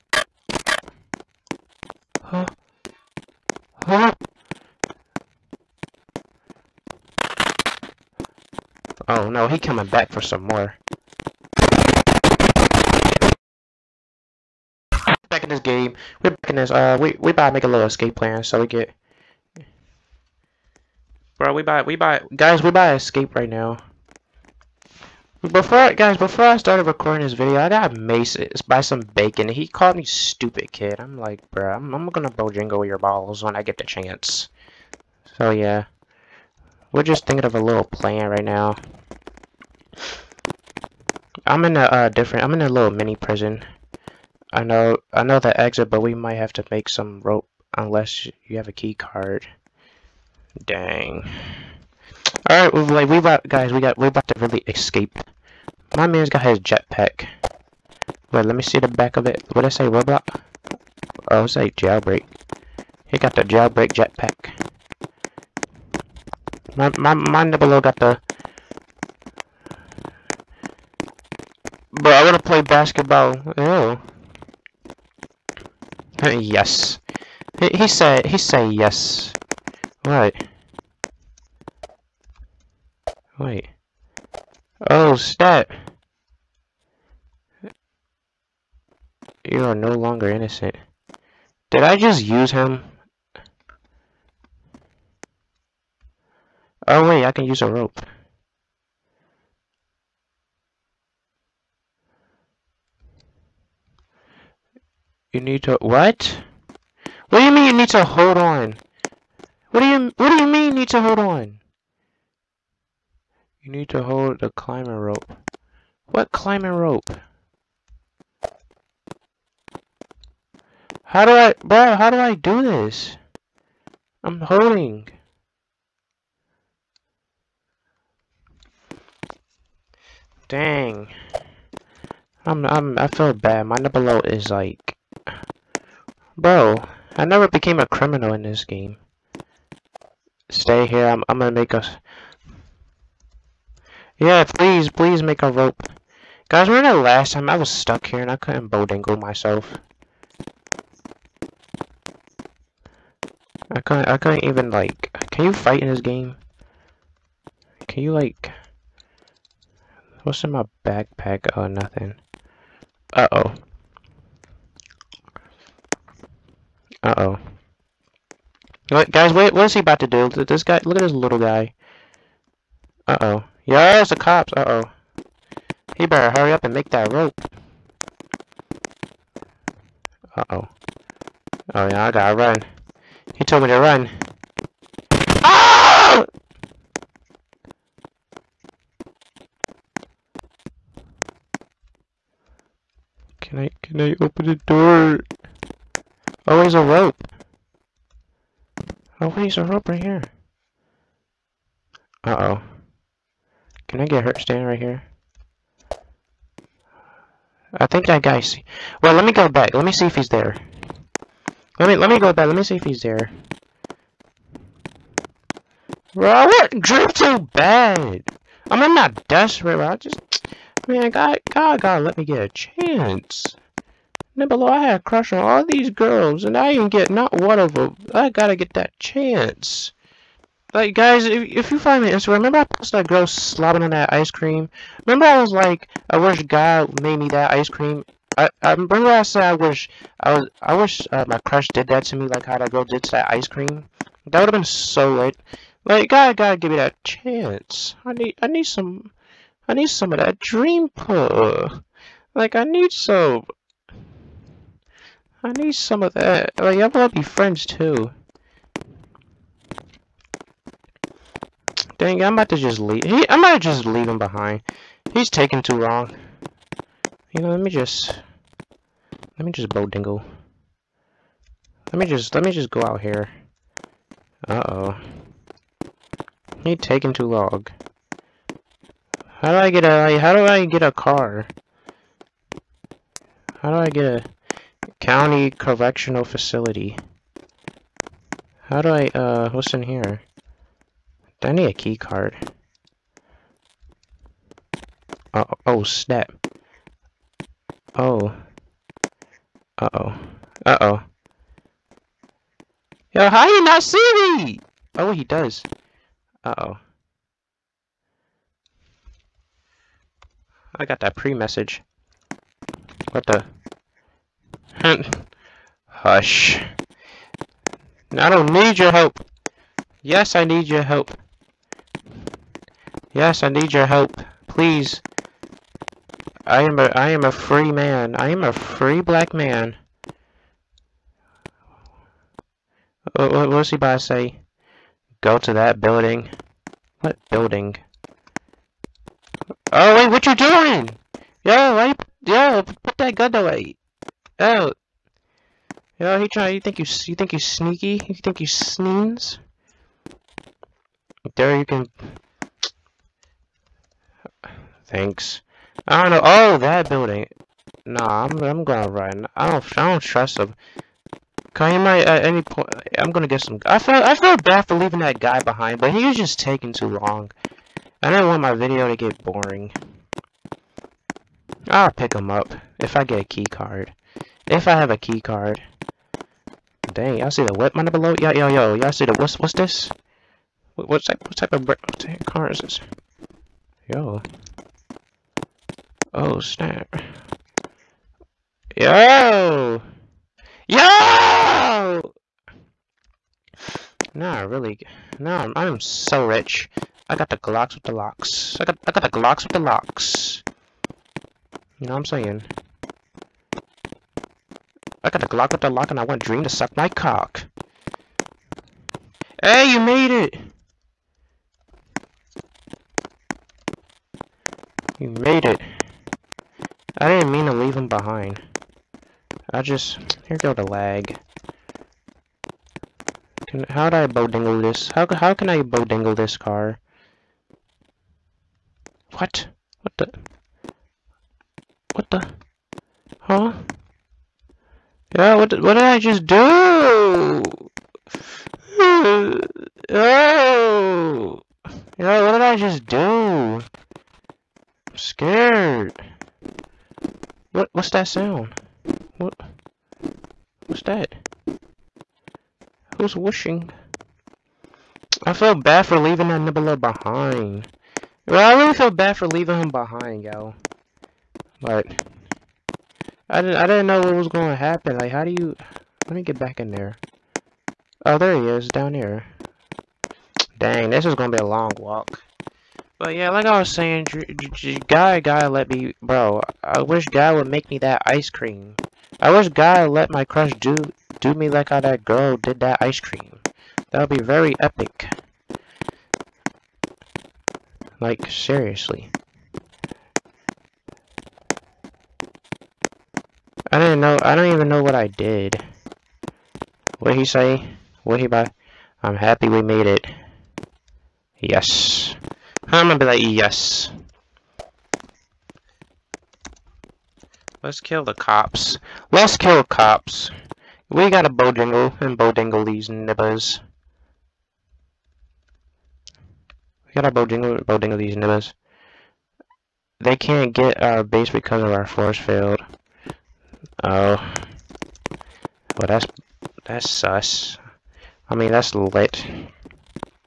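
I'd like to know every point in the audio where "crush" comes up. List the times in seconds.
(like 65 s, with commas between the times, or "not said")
225 s, 241 s, 480 s.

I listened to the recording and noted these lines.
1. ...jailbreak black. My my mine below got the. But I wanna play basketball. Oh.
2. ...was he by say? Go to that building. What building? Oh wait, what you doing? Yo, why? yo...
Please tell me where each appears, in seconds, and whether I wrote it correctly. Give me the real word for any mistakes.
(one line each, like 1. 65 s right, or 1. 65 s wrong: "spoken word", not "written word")
1. 63 s wrong: "jetpack", not "black"
2. 333 s right.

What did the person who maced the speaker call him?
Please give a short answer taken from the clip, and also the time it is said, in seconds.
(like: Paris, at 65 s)
stupid kid, at 30 s.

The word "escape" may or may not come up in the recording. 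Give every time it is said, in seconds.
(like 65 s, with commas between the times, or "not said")
17 s, 22 s, 54 s.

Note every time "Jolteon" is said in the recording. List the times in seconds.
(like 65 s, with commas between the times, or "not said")
not said.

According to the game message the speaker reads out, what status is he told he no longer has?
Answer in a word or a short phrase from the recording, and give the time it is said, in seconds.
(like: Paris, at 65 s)
innocent, at 90 s.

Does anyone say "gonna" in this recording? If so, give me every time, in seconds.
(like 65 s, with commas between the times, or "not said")
32 s, 141 s, 363 s, 471 s.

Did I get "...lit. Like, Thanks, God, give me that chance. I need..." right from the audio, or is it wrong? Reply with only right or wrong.
wrong.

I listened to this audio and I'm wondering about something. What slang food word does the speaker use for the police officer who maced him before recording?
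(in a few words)
bacon.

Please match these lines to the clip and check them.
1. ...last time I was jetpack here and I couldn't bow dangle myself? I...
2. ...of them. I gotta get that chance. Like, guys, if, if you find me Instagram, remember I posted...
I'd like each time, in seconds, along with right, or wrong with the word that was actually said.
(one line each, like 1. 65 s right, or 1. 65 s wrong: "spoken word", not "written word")
1. 147 s wrong: "stuck", not "jetpack"
2. 227 s right.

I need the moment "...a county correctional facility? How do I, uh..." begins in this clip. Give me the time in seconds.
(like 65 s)
284 s.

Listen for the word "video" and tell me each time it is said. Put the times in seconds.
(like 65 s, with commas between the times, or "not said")
27 s, 368 s.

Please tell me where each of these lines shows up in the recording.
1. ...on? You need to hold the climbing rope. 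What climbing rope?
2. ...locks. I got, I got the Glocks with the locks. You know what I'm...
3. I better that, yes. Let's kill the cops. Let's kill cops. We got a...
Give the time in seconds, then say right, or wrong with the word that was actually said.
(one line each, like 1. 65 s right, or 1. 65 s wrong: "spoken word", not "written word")
1. 111 s right
2. 397 s right
3. 502 s wrong: "remember", not "better".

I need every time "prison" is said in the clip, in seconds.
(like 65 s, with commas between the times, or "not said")
43 s.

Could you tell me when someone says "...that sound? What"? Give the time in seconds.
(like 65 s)
447 s.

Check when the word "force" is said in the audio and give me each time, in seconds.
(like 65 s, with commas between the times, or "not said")
521 s.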